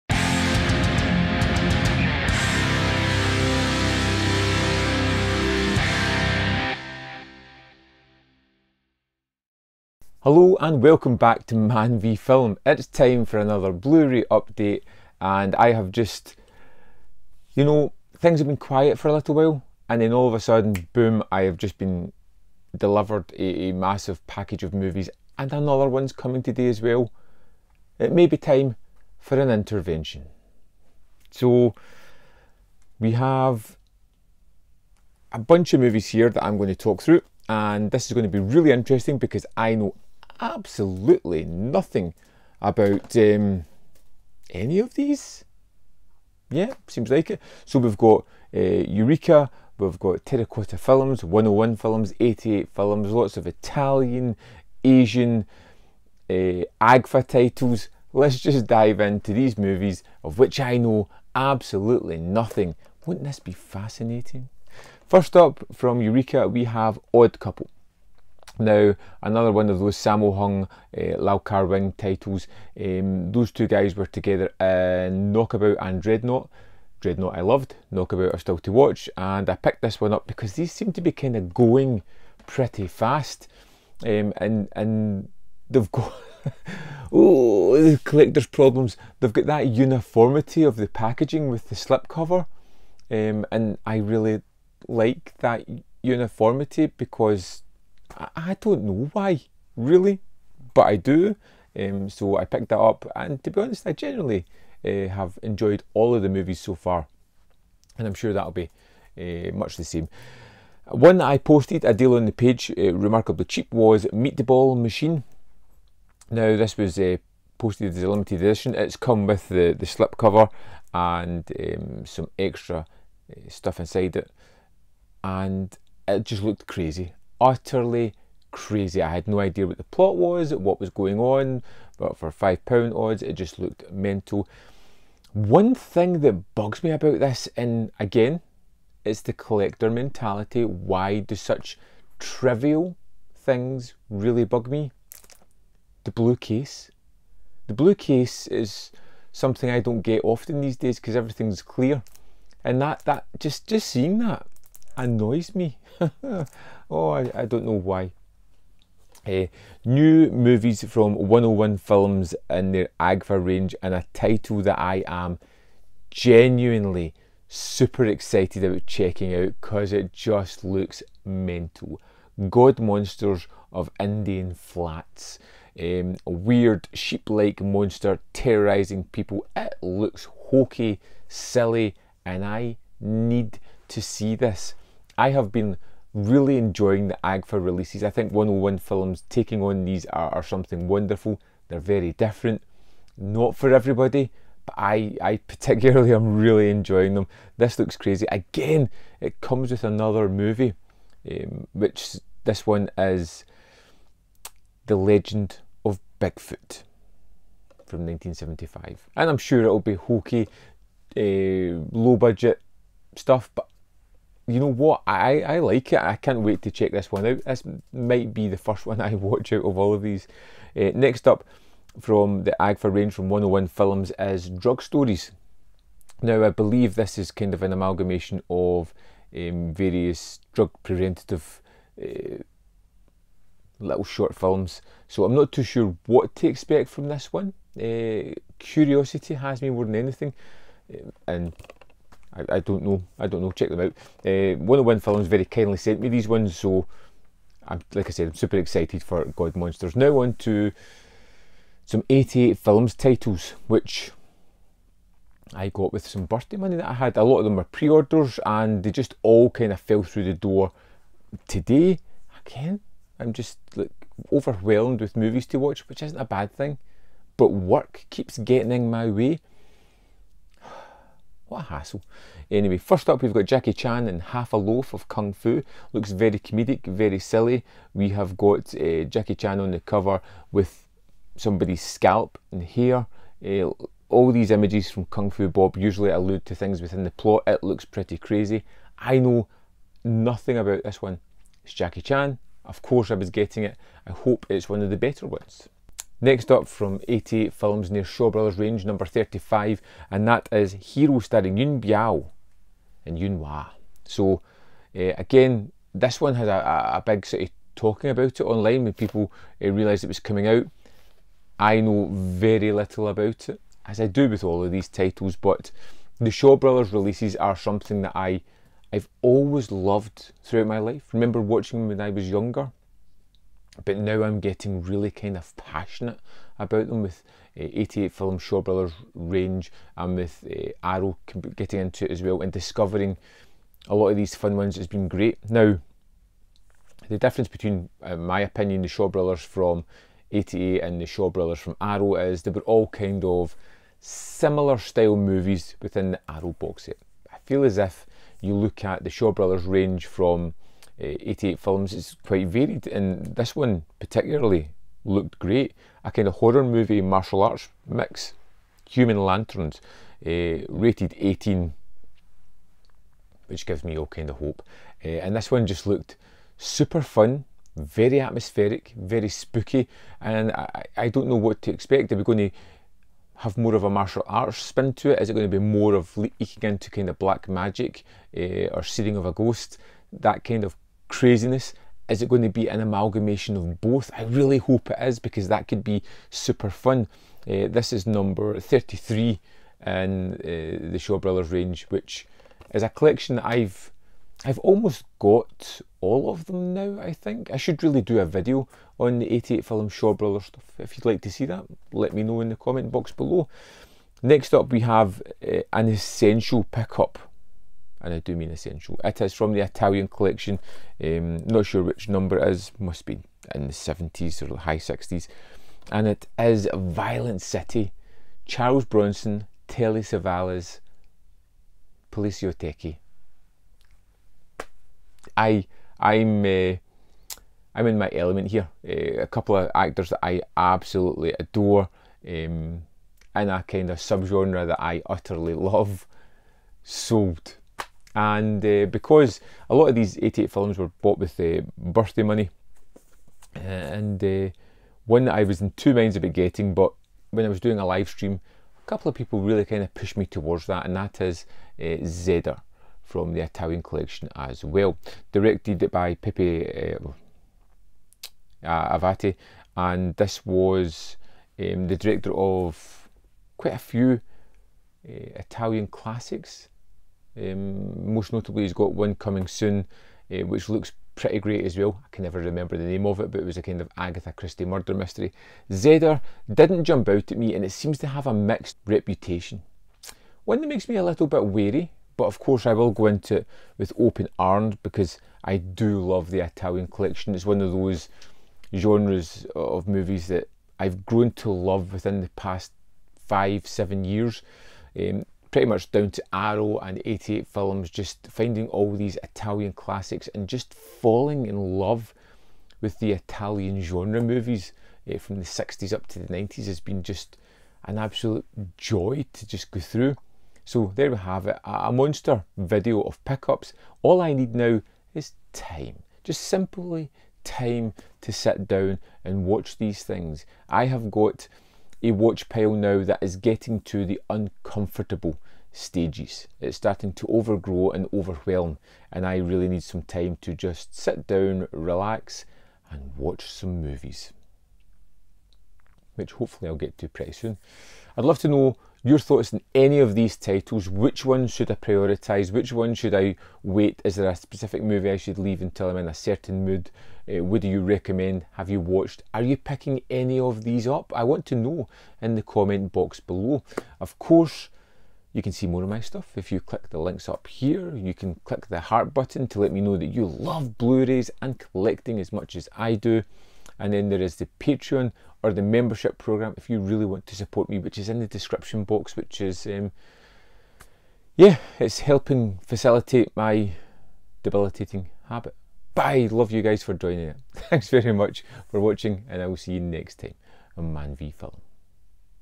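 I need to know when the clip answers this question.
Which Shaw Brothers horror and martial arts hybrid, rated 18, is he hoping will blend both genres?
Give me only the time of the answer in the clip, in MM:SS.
05:58.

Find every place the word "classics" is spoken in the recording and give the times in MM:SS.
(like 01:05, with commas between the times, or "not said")
07:45, 08:19.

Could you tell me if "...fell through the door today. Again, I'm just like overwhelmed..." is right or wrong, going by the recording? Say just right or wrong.
right.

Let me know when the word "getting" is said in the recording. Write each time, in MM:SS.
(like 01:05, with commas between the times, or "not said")
04:28, 04:53, 05:24, 05:31, 07:26, 08:43.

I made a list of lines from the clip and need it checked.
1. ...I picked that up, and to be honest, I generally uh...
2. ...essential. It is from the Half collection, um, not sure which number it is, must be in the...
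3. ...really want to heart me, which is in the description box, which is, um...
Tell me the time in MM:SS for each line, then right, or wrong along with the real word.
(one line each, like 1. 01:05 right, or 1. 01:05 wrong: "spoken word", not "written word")
1. 01:42 right
2. 06:48 wrong: "Italian", not "Half"
3. 09:26 wrong: "support", not "heart".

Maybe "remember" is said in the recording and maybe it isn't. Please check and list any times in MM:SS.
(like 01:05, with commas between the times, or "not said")
05:21, 07:52.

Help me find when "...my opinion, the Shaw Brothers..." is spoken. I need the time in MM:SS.
05:38.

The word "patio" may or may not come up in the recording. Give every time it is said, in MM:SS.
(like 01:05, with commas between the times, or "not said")
not said.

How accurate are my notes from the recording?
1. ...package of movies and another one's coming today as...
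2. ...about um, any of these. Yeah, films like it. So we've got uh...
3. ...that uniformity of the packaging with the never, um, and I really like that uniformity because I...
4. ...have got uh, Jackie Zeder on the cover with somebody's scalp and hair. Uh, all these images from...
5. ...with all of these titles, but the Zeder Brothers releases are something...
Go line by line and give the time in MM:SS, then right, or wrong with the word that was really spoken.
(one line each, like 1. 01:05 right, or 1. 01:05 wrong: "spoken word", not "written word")
1. 00:24 right
2. 00:42 wrong: "seems", not "films"
3. 01:29 wrong: "slipcover", not "never"
4. 04:38 wrong: "Chan", not "Zeder"
5. 05:14 wrong: "Shaw", not "Zeder".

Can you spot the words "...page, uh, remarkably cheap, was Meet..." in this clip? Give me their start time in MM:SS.
01:52.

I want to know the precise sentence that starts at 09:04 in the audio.
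Is there a specific movie I should leave until I'm in a certain mood?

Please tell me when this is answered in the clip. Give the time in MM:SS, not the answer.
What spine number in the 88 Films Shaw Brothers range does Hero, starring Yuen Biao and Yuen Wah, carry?
04:58.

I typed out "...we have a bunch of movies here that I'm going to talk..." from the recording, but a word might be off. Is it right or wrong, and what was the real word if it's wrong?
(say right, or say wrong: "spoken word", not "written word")
right.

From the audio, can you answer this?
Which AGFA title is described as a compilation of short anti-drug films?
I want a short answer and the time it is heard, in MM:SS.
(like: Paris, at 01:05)
Drug Stories, at 03:44.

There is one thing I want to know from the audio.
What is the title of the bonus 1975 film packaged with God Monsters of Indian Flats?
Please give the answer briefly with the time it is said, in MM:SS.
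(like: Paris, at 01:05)
The Legend of Bigfoot, at 03:24.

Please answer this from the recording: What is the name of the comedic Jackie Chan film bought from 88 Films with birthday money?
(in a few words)
Half a Loaf of Kung Fu.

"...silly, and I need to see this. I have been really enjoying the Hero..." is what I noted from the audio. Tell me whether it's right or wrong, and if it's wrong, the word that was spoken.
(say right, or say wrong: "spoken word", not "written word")
wrong: "AGFA", not "Hero".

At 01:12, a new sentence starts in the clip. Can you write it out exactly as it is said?
Um, those two guys were together in Knockabout and Dreadnought.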